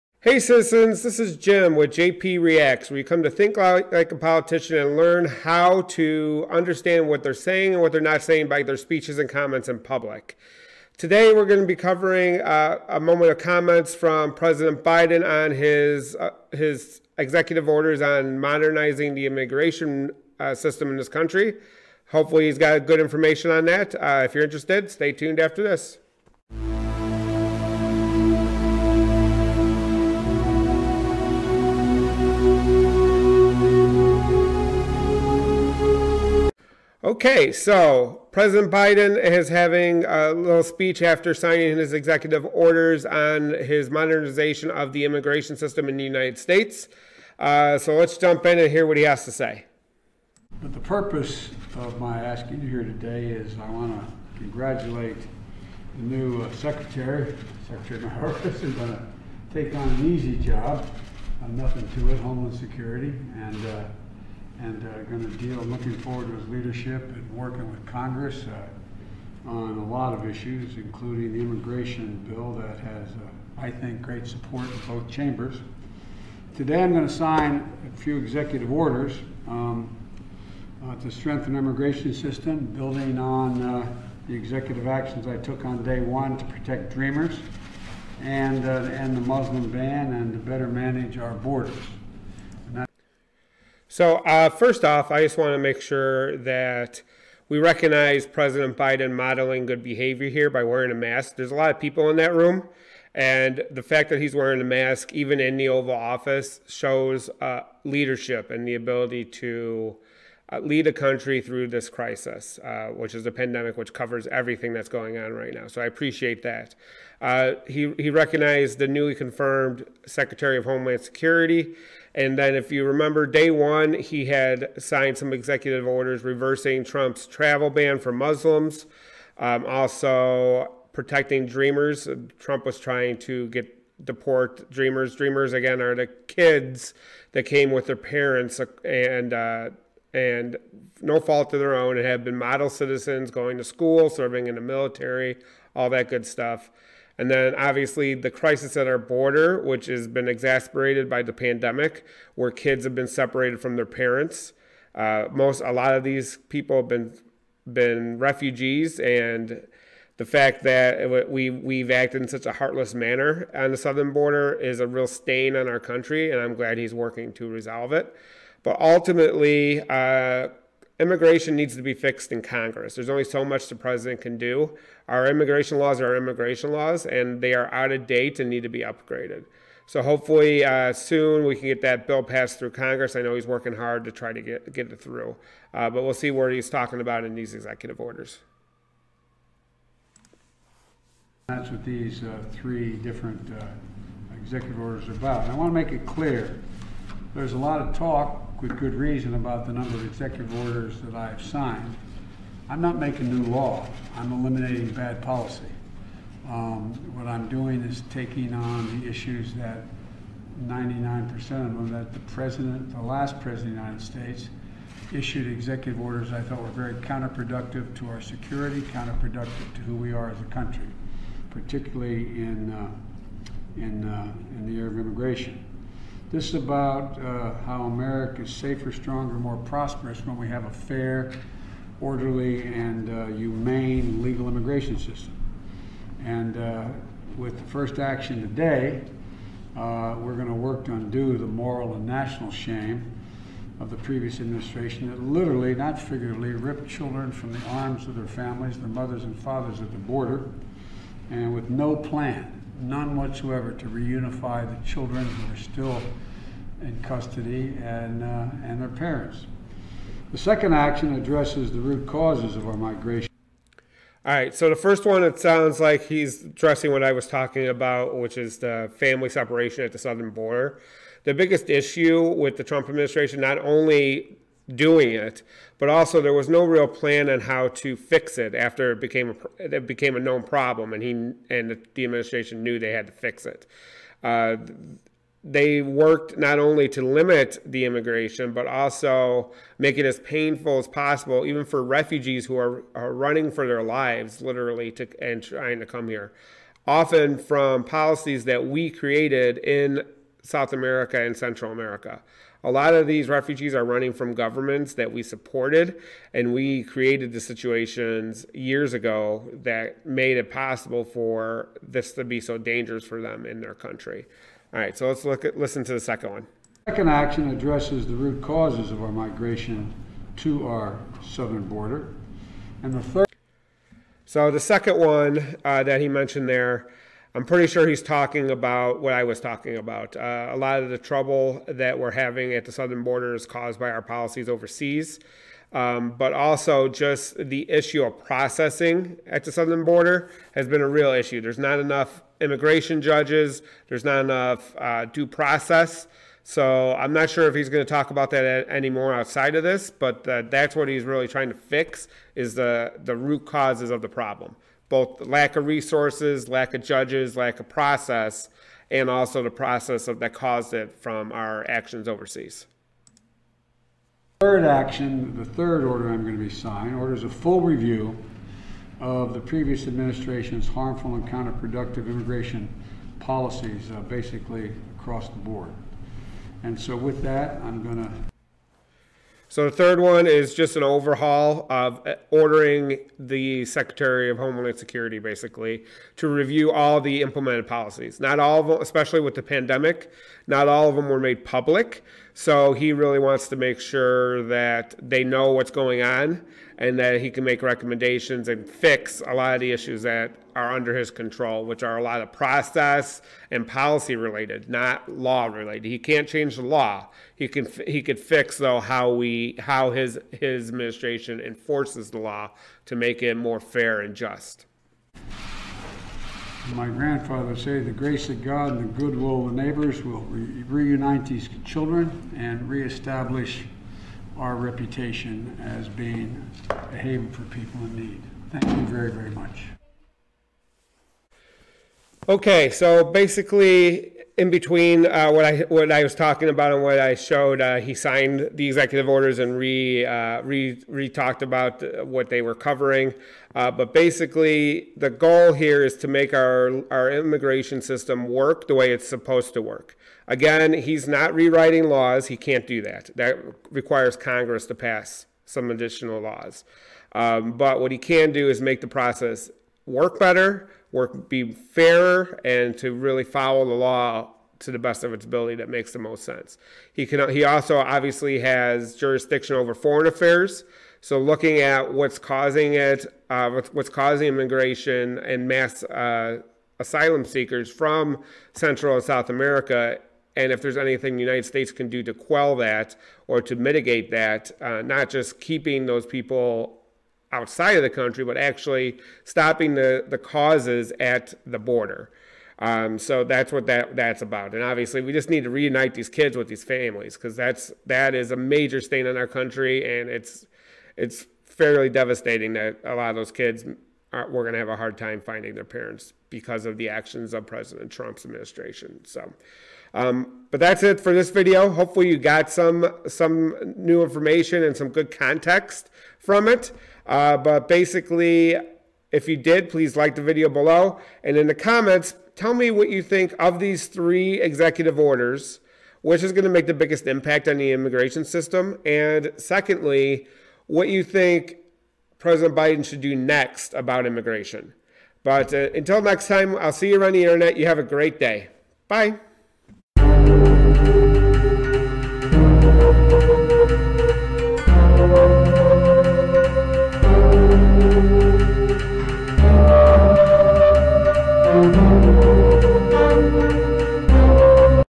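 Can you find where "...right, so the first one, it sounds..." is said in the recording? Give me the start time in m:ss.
4:24.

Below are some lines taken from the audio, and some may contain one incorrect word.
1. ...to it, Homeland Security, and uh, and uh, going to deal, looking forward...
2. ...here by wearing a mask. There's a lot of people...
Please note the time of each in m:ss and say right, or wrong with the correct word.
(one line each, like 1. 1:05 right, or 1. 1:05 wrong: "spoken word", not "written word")
1. 1:01 right
2. 1:40 right.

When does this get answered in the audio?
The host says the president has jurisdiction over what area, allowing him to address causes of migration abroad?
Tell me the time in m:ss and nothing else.
7:49.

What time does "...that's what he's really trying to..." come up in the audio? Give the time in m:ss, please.
5:50.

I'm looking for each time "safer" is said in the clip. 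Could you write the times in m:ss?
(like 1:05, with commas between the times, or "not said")
3:48.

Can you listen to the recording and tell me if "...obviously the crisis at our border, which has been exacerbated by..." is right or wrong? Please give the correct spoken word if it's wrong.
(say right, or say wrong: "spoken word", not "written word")
right.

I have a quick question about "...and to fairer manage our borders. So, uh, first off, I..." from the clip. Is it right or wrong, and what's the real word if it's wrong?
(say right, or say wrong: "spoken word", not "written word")
wrong: "better", not "fairer".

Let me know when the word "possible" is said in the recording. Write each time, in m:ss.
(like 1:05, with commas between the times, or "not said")
4:50, 5:10.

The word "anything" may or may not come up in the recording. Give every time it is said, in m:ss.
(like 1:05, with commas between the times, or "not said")
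8:00.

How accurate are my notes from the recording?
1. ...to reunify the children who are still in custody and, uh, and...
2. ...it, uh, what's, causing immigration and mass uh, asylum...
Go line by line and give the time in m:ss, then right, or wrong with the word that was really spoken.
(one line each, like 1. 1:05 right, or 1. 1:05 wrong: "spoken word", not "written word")
1. 4:13 right
2. 7:52 right.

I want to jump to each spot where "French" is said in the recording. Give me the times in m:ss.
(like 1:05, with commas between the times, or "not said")
not said.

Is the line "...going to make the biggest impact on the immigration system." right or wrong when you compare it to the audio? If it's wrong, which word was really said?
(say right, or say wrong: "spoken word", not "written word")
right.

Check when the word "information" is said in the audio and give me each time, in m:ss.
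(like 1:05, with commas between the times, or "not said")
0:22, 8:34.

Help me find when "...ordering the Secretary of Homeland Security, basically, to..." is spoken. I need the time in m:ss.
6:22.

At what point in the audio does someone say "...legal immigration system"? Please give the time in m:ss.
3:54.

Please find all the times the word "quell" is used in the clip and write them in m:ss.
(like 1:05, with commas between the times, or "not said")
8:02.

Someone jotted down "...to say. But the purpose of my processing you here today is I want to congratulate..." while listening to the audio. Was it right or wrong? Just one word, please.
wrong.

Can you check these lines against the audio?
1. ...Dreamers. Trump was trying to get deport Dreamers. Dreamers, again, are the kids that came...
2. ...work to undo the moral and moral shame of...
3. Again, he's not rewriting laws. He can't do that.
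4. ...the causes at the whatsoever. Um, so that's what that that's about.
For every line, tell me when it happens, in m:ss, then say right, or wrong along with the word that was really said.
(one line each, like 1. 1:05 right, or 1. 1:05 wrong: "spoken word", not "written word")
1. 2:11 right
2. 4:00 wrong: "national", not "moral"
3. 7:30 right
4. 8:10 wrong: "border", not "whatsoever".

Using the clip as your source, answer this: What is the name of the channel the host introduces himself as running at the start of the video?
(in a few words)
JP Reacts.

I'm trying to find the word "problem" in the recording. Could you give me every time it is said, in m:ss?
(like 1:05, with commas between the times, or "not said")
4:40, 5:54.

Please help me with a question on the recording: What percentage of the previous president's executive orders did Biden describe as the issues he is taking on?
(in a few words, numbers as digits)
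99%.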